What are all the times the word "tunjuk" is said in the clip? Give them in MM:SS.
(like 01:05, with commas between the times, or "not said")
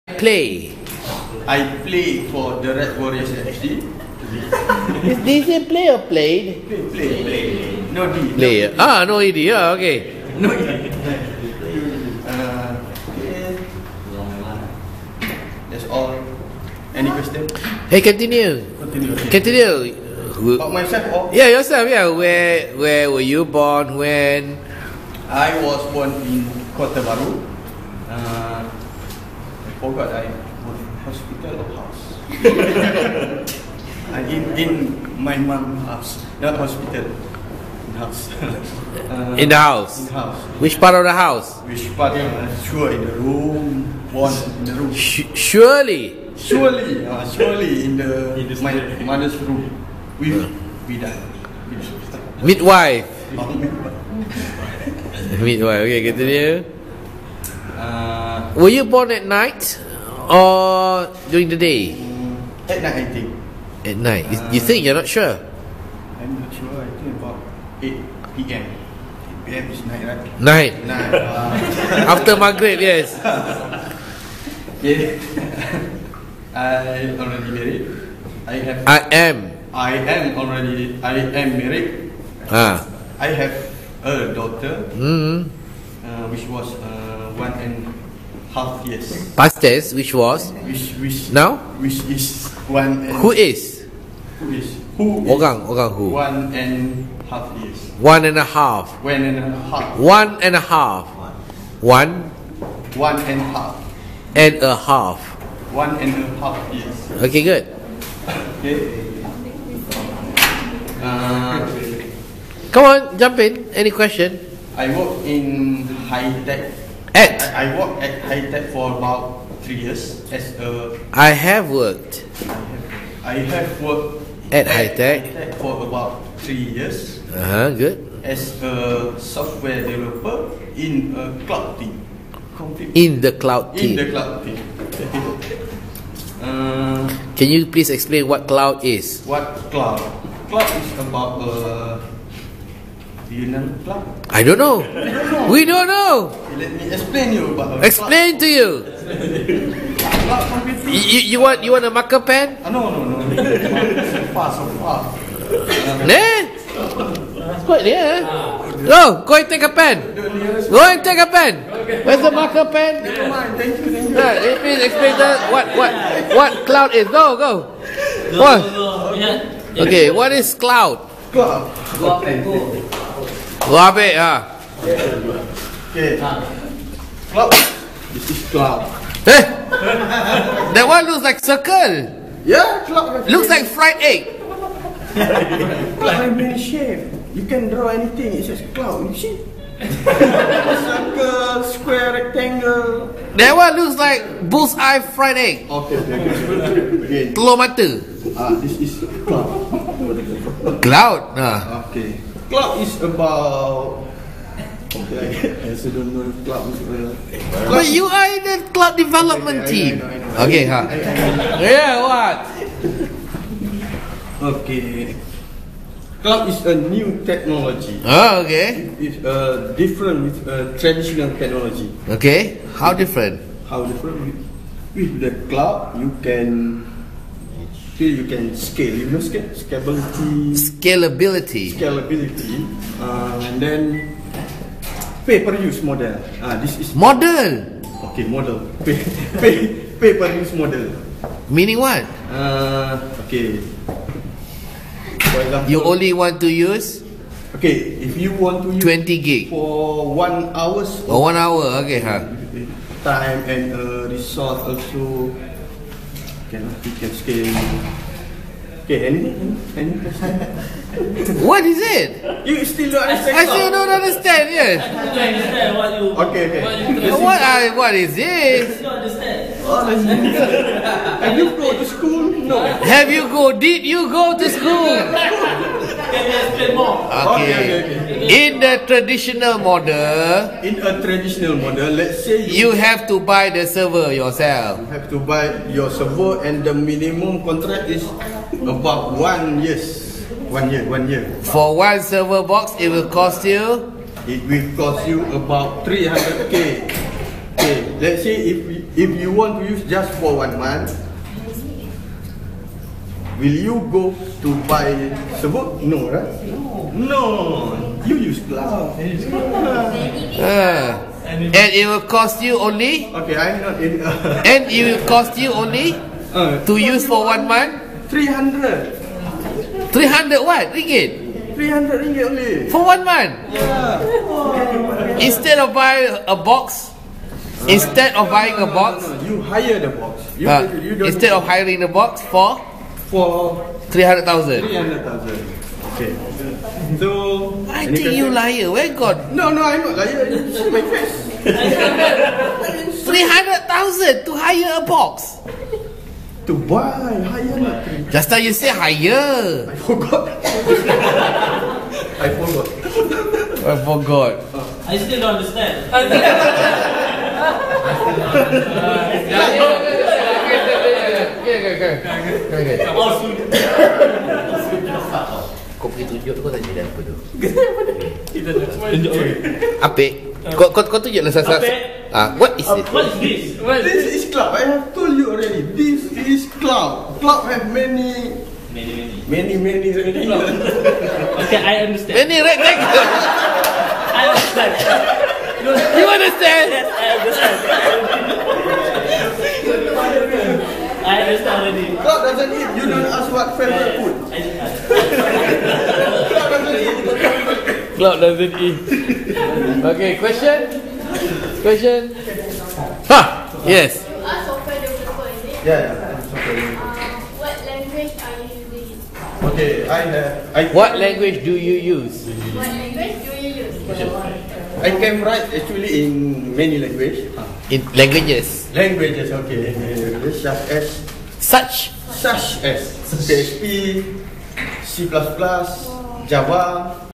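06:06, 06:11.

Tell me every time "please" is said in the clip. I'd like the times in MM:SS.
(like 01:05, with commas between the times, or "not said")
02:17, 02:44.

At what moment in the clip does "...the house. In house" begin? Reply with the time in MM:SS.
00:39.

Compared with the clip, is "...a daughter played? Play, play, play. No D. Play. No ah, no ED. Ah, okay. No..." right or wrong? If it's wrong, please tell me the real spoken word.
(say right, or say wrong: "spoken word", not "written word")
wrong: "player", not "daughter".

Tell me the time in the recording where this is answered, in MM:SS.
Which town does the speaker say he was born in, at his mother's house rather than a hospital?
00:26.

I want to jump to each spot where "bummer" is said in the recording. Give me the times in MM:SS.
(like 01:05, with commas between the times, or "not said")
not said.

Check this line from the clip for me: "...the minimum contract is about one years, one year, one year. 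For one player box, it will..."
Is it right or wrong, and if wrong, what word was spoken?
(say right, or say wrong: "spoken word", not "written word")
wrong: "server", not "player".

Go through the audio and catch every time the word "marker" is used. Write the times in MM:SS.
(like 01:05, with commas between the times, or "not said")
02:31, 02:42.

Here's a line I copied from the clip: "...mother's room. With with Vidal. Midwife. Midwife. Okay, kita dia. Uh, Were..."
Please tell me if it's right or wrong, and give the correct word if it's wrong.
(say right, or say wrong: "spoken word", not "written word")
right.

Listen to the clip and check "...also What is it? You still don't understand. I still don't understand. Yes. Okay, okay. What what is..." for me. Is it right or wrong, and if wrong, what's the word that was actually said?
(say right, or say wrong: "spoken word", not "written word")
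right.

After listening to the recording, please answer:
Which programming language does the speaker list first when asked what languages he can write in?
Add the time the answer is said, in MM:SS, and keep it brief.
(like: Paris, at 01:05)
PHP, at 07:03.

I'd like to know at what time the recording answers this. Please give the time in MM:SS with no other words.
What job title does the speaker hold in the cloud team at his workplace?
02:09.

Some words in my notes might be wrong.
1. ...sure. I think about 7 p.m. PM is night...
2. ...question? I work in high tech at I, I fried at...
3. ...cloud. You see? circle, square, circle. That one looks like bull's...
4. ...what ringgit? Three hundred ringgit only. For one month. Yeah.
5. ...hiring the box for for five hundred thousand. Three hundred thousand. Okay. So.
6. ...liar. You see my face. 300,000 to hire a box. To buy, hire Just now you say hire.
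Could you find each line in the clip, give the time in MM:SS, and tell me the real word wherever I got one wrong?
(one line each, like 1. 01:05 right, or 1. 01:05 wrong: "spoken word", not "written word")
1. 01:06 wrong: "8", not "7"
2. 01:53 wrong: "worked", not "fried"
3. 03:08 wrong: "rectangle", not "circle"
4. 05:20 right
5. 05:31 wrong: "three", not "five"
6. 05:40 right.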